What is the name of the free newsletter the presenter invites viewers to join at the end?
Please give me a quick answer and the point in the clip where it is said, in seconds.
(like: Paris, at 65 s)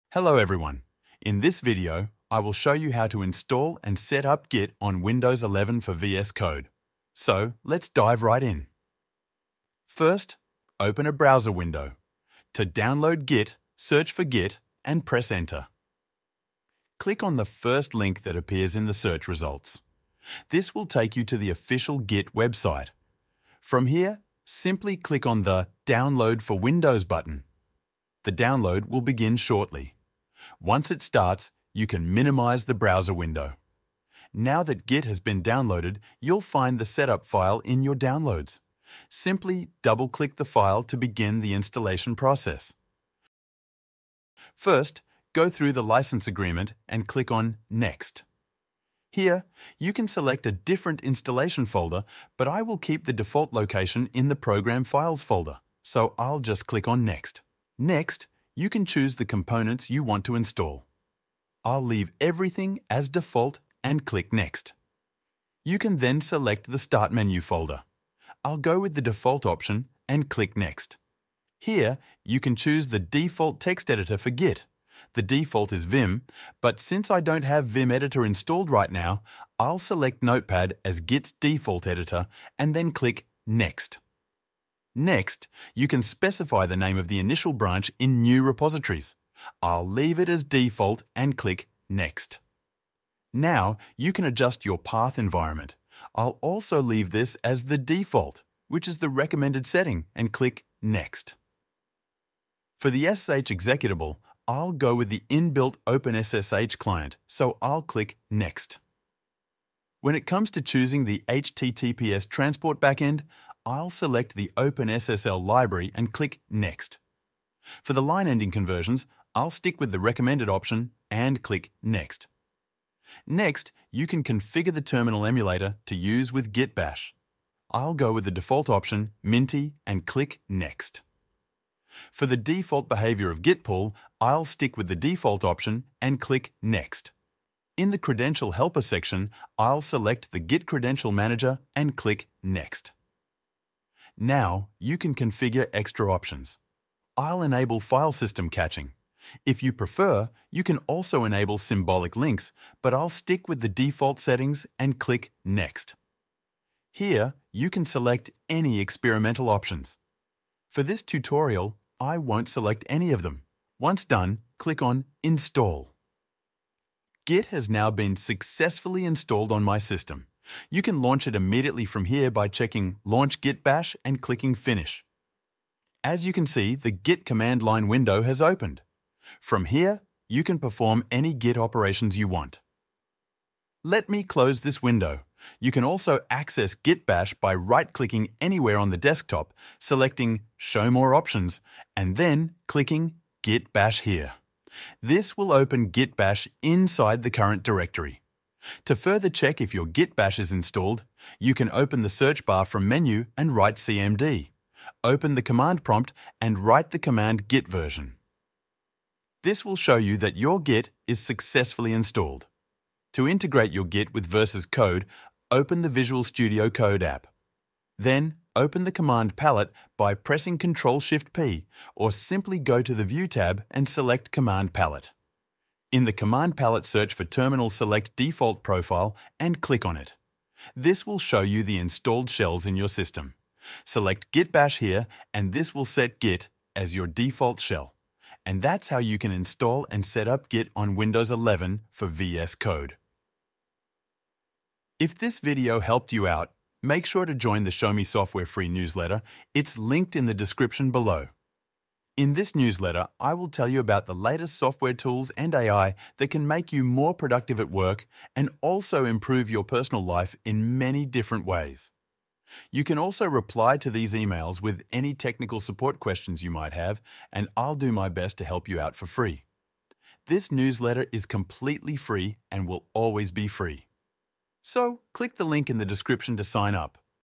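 Show Me Software, at 247 s.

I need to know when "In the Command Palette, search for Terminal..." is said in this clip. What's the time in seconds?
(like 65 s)
225 s.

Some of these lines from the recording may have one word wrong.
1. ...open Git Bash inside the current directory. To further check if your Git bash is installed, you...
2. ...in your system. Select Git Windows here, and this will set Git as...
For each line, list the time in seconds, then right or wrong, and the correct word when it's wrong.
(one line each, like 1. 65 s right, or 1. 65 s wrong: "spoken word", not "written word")
1. 195 s right
2. 232 s wrong: "Bash", not "Windows".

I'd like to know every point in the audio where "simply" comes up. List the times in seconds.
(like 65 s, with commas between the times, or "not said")
24 s, 39 s, 222 s.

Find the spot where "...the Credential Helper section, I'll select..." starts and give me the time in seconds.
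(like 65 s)
137 s.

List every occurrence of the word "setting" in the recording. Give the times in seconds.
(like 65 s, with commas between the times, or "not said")
99 s, 154 s.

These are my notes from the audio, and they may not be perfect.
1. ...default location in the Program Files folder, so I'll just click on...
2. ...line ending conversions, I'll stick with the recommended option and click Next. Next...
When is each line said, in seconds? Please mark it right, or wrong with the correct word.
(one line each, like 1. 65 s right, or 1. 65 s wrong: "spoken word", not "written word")
1. 53 s right
2. 118 s right.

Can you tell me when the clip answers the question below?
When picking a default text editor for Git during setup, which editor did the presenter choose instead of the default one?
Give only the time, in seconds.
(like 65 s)
80 s.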